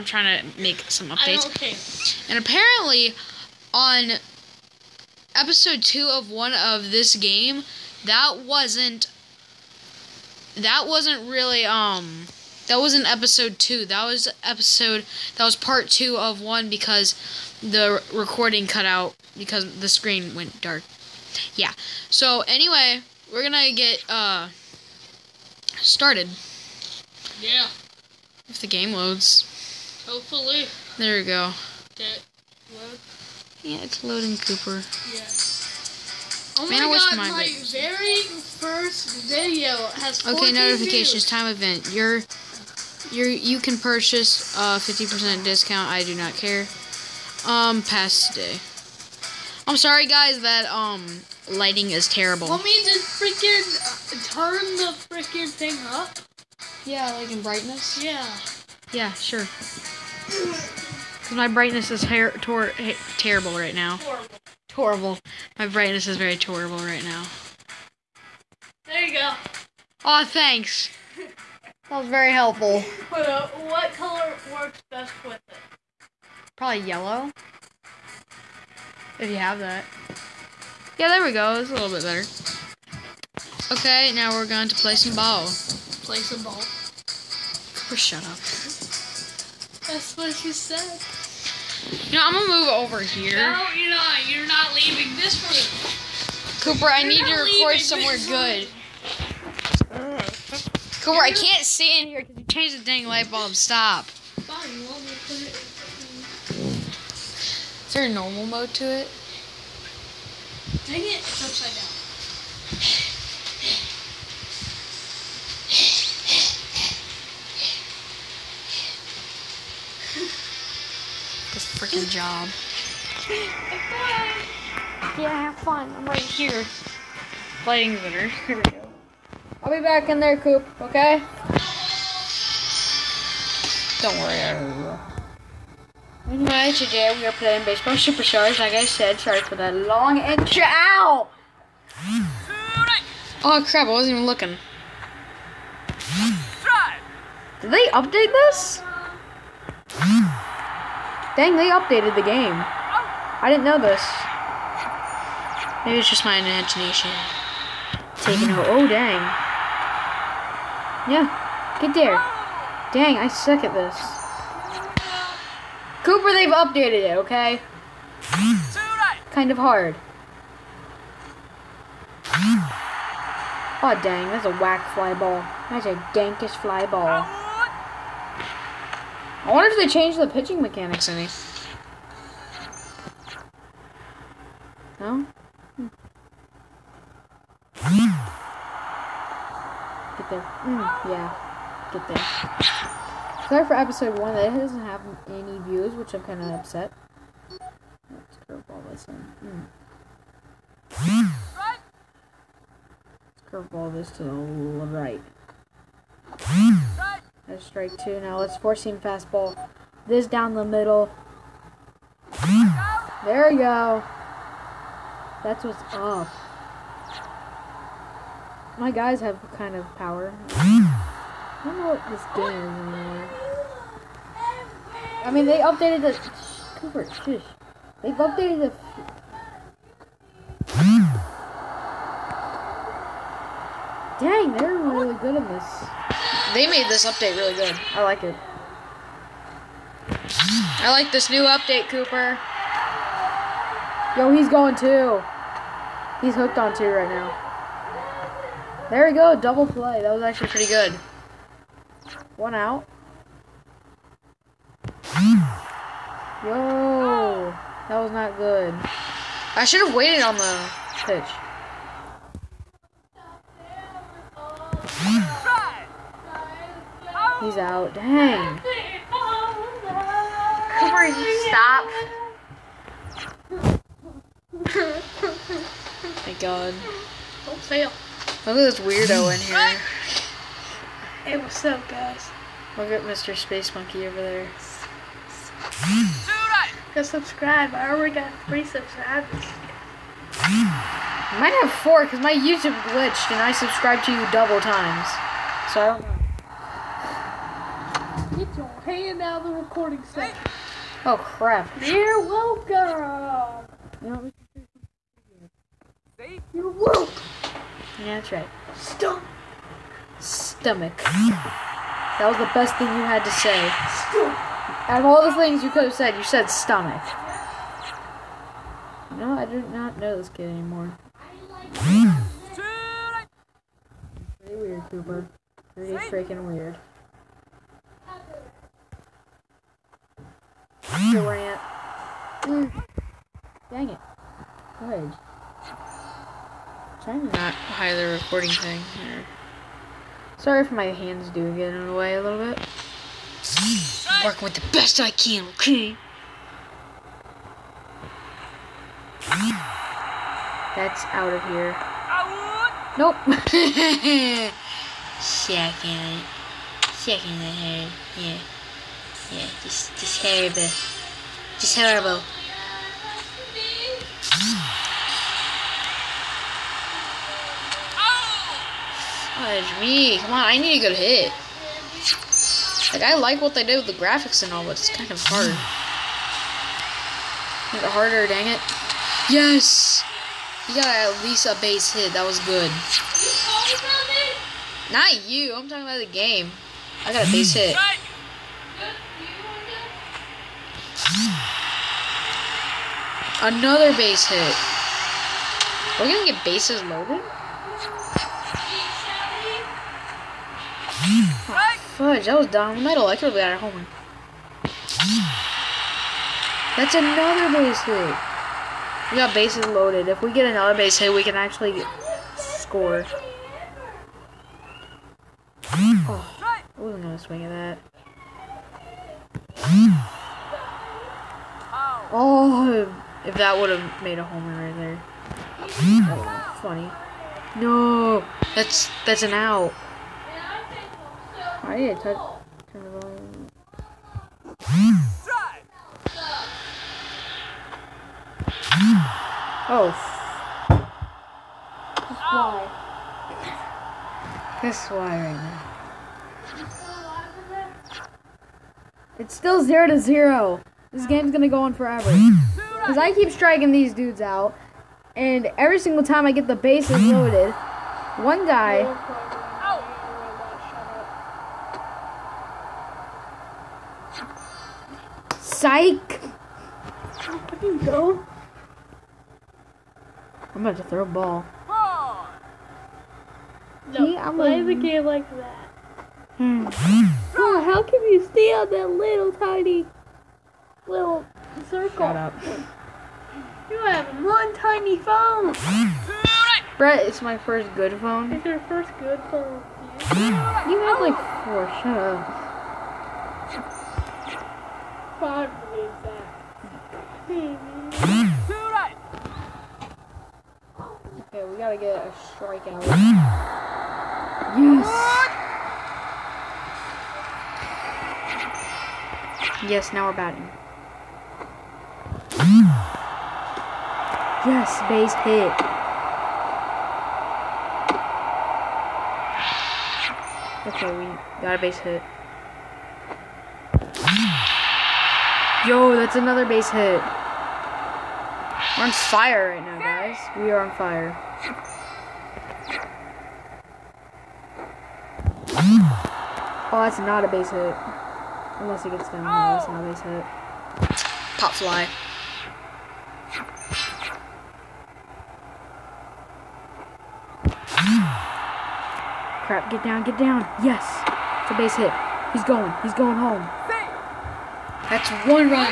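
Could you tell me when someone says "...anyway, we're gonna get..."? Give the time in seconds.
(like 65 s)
22 s.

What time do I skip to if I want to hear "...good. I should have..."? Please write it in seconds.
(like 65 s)
258 s.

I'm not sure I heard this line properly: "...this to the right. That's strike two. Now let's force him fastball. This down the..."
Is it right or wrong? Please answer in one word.
right.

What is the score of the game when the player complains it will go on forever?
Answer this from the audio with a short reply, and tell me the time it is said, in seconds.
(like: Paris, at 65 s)
0 to 0, at 449 s.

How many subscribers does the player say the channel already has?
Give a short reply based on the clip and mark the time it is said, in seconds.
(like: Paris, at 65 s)
3, at 288 s.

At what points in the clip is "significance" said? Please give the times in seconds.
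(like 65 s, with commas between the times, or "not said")
not said.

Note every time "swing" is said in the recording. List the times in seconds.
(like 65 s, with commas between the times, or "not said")
417 s.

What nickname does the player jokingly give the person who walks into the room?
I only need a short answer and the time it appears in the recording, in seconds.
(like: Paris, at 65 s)
Mr. Space Monkey, at 283 s.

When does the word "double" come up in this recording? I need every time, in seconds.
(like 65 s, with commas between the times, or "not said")
249 s, 294 s.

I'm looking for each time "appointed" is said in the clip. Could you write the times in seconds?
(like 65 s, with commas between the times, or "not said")
not said.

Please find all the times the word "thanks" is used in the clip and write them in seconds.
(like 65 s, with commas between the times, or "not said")
70 s, 276 s.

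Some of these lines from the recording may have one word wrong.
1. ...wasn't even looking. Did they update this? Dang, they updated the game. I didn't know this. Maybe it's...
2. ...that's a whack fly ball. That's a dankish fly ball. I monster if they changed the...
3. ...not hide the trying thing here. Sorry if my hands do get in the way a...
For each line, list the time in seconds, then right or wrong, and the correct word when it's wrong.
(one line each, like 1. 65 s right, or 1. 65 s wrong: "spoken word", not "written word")
1. 143 s right
2. 174 s wrong: "wonder", not "monster"
3. 337 s wrong: "recording", not "trying".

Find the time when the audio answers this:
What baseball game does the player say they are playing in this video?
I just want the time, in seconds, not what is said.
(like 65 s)
137 s.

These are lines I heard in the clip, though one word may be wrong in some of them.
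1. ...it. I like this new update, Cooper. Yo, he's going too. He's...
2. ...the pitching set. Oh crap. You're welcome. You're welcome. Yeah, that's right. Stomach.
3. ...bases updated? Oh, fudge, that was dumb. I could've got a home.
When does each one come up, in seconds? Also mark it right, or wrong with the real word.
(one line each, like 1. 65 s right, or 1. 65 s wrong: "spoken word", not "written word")
1. 238 s right
2. 299 s wrong: "recording", not "pitching"
3. 396 s wrong: "loaded", not "updated".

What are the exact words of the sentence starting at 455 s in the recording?
And every single time I get the bases loaded, one guy...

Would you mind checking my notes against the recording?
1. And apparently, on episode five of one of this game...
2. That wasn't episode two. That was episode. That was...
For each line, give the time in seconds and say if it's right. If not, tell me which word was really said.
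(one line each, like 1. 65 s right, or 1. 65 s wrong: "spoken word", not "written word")
1. 2 s wrong: "two", not "five"
2. 12 s right.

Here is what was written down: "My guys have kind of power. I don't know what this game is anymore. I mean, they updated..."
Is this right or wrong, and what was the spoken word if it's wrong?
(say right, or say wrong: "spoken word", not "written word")
right.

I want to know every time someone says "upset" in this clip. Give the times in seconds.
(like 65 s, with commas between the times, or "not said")
196 s.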